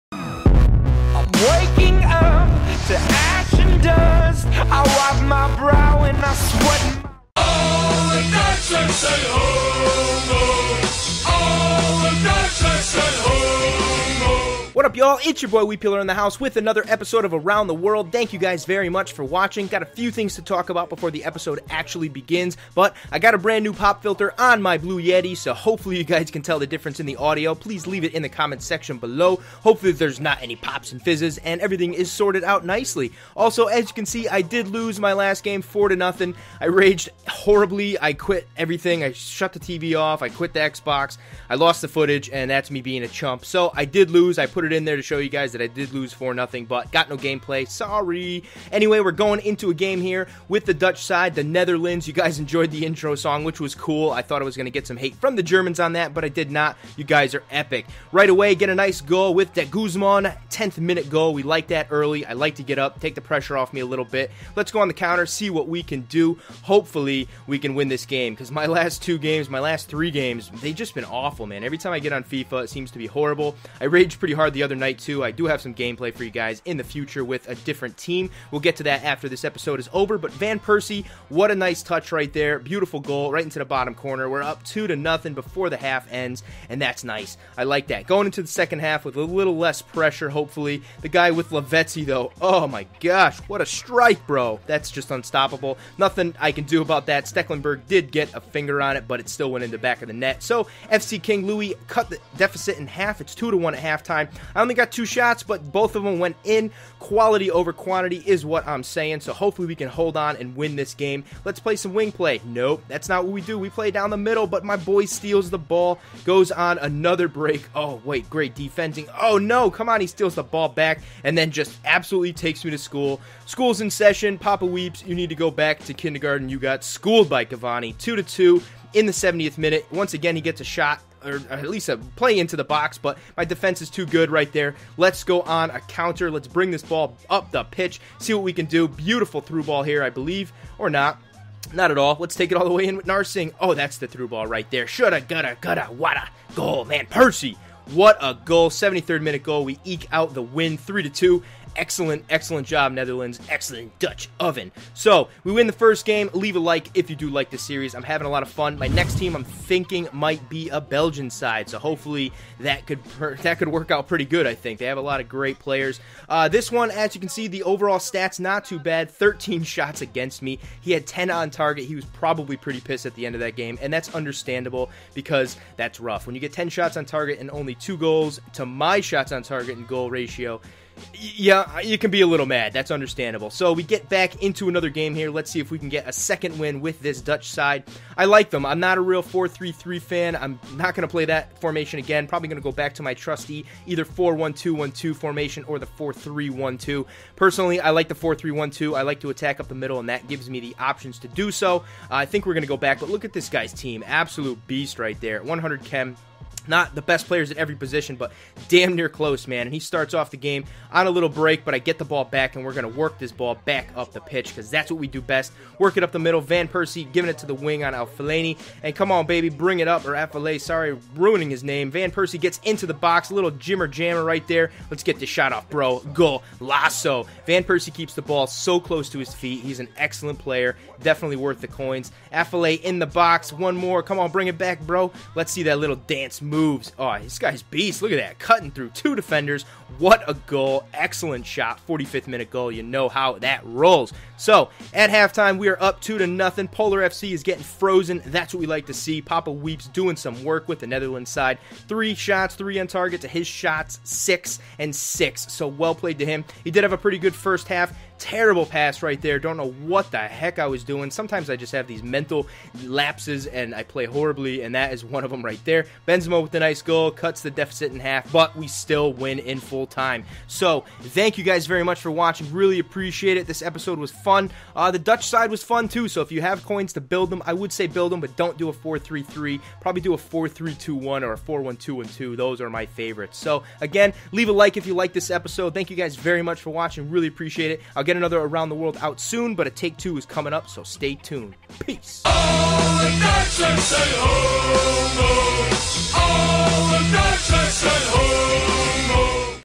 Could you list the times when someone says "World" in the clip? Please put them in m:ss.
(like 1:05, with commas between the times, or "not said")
0:17, 4:48.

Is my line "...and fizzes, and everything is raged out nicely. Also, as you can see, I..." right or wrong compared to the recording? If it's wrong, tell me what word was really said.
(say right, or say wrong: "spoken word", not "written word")
wrong: "sorted", not "raged".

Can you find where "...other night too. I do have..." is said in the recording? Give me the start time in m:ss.
1:14.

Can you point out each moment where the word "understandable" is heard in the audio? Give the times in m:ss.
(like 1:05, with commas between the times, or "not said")
2:54, 3:02.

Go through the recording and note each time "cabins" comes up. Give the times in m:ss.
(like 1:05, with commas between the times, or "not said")
not said.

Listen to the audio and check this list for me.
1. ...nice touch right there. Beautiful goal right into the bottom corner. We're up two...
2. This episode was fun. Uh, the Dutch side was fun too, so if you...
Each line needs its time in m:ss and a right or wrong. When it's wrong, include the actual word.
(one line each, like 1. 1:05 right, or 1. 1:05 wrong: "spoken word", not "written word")
1. 1:21 right
2. 4:33 right.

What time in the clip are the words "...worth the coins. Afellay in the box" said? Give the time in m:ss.
3:51.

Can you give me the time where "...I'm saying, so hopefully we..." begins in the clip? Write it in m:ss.
1:48.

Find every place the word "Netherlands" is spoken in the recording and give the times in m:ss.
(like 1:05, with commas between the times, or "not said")
0:51, 2:32, 4:10.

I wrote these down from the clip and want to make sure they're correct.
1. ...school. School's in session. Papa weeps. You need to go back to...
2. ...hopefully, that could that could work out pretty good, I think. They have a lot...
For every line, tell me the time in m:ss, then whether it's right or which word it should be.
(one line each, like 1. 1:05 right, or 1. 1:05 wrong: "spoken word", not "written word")
1. 2:02 right
2. 2:41 right.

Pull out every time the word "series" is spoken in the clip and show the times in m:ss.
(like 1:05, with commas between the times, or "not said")
2:37.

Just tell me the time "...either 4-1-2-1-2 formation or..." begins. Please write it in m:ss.
3:13.